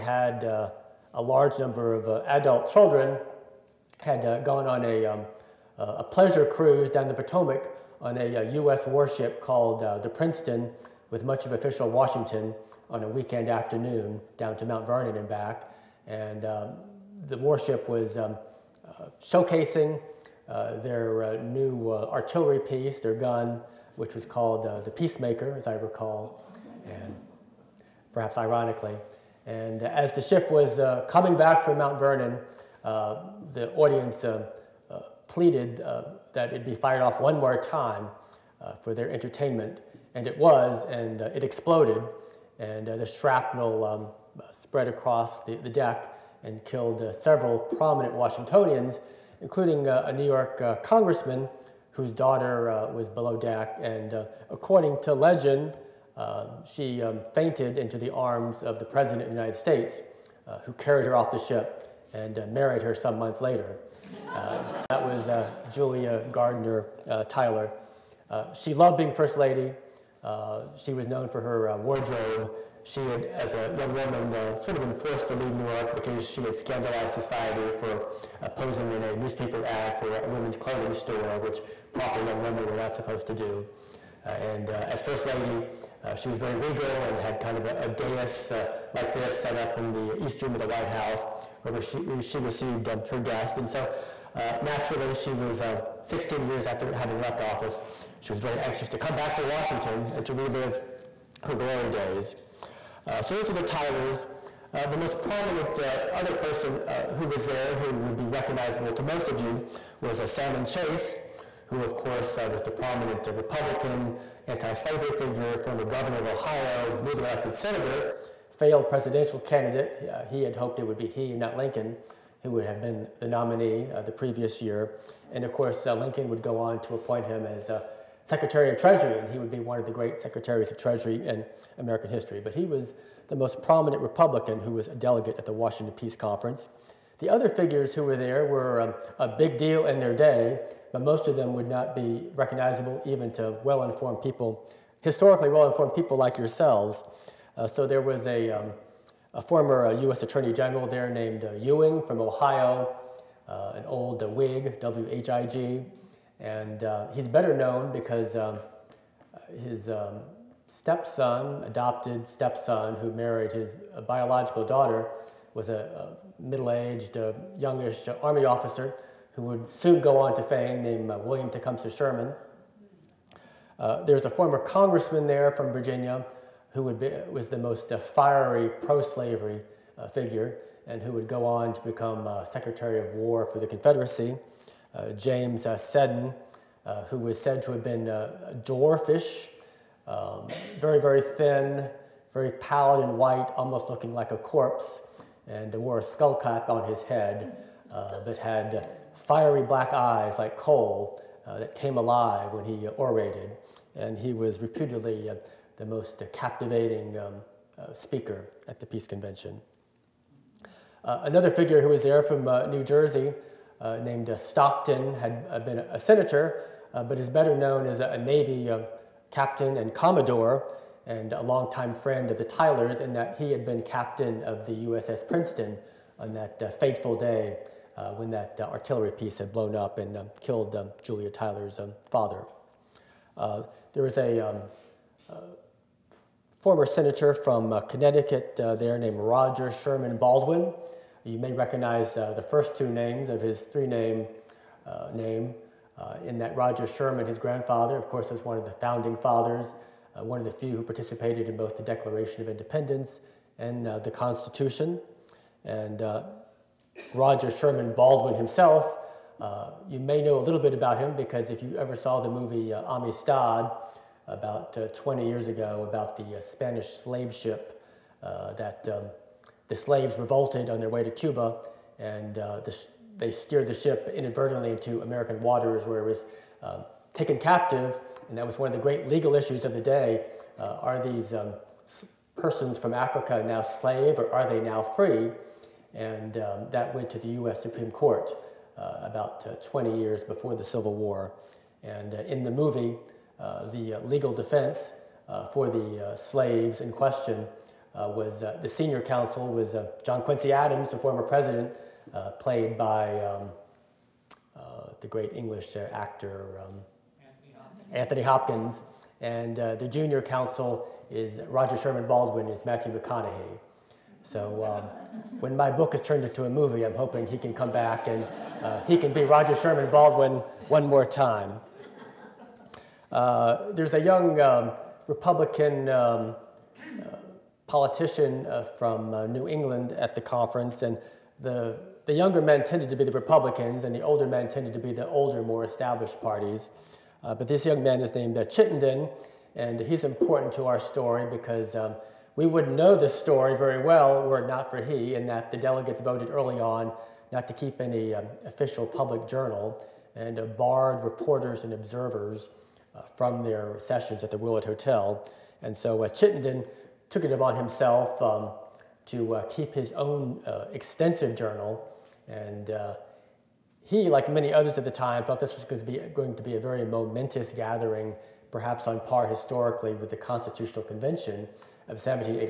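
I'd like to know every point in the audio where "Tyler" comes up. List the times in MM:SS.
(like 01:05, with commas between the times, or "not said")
01:07, 01:43, 03:42, 03:51.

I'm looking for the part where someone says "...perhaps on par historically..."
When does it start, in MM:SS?
06:08.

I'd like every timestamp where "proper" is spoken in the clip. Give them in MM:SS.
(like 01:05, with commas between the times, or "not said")
01:21.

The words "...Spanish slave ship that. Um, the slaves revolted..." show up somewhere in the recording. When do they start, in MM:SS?
04:26.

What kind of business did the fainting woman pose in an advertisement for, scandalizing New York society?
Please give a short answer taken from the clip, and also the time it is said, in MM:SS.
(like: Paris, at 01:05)
women's clothing store, at 01:20.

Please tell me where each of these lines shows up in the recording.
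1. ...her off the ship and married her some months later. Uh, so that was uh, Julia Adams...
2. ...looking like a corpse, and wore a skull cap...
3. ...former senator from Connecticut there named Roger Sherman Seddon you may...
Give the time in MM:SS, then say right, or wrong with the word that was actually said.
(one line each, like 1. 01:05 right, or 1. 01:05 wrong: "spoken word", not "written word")
1. 01:01 wrong: "Gardiner", not "Adams"
2. 03:13 right
3. 03:56 wrong: "Baldwin", not "Seddon".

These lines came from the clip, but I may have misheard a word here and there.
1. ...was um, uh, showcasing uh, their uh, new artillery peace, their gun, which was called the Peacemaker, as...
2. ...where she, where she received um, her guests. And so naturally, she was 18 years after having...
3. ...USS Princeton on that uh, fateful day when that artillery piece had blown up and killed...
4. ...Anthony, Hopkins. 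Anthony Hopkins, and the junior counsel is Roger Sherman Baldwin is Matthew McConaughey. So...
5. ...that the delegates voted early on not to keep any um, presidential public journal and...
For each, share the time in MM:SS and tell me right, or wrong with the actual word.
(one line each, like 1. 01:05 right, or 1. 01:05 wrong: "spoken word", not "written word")
1. 00:17 wrong: "piece", not "peace"
2. 01:31 wrong: "16", not "18"
3. 03:44 right
4. 05:07 right
5. 05:45 wrong: "official", not "presidential".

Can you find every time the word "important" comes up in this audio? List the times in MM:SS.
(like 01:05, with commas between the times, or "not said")
05:40.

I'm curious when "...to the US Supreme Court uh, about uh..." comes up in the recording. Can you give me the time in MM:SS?
04:47.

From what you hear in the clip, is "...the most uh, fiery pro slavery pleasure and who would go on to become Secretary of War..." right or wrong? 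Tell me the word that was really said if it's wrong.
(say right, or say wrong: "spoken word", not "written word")
wrong: "figure", not "pleasure".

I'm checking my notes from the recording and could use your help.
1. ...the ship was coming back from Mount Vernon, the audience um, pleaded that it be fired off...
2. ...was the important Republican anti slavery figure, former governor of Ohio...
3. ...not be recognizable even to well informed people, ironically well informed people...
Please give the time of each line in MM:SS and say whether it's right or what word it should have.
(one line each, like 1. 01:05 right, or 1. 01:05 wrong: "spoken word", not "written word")
1. 00:30 right
2. 01:52 wrong: "prominent", not "important"
3. 02:21 wrong: "historically", not "ironically".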